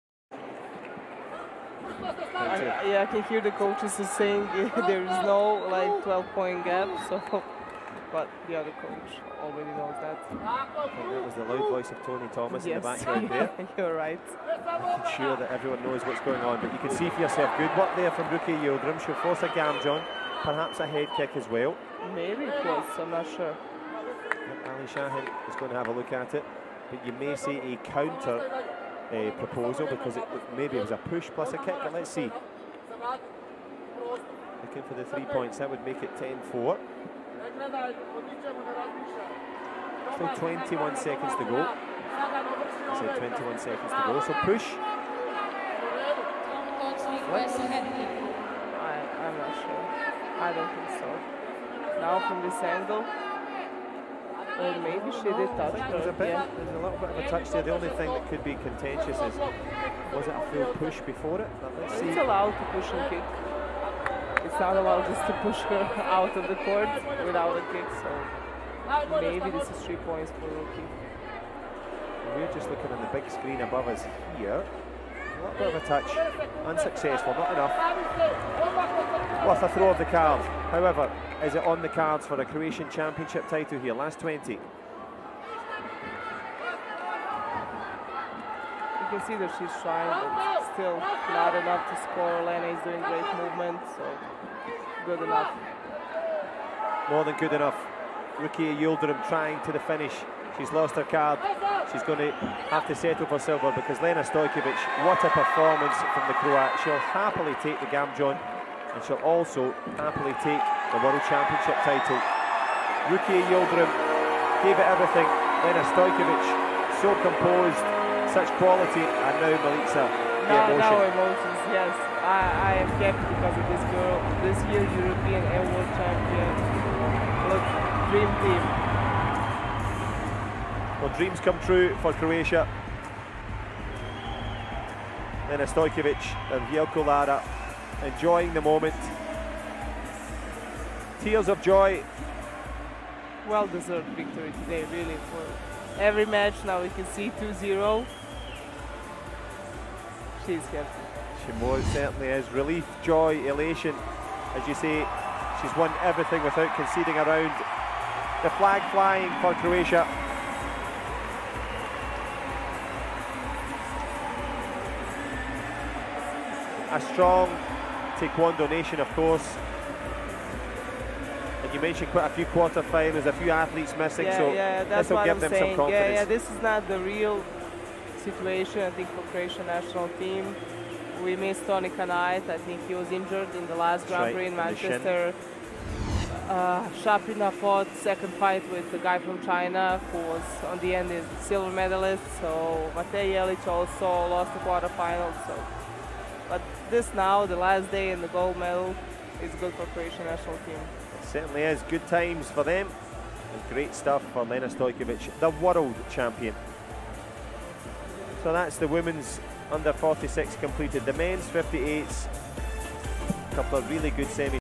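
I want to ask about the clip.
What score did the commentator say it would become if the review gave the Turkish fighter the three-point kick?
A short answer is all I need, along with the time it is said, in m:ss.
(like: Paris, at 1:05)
10-4, at 0:36.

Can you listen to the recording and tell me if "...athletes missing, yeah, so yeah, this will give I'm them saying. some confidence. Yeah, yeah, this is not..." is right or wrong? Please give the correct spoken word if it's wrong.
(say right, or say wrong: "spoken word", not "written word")
right.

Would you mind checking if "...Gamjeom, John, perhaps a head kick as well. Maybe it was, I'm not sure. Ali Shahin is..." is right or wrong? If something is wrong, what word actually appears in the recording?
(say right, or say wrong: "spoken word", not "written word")
right.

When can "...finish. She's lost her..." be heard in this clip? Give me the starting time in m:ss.
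1:39.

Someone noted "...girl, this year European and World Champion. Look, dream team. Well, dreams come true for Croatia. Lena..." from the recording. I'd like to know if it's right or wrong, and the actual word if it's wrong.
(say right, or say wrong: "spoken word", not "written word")
right.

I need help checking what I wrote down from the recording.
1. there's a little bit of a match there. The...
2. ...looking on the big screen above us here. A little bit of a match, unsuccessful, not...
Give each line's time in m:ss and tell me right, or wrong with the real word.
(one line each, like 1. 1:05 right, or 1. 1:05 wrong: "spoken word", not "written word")
1. 0:56 wrong: "touch", not "match"
2. 1:12 wrong: "touch", not "match".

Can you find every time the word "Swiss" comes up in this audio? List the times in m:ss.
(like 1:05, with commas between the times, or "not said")
not said.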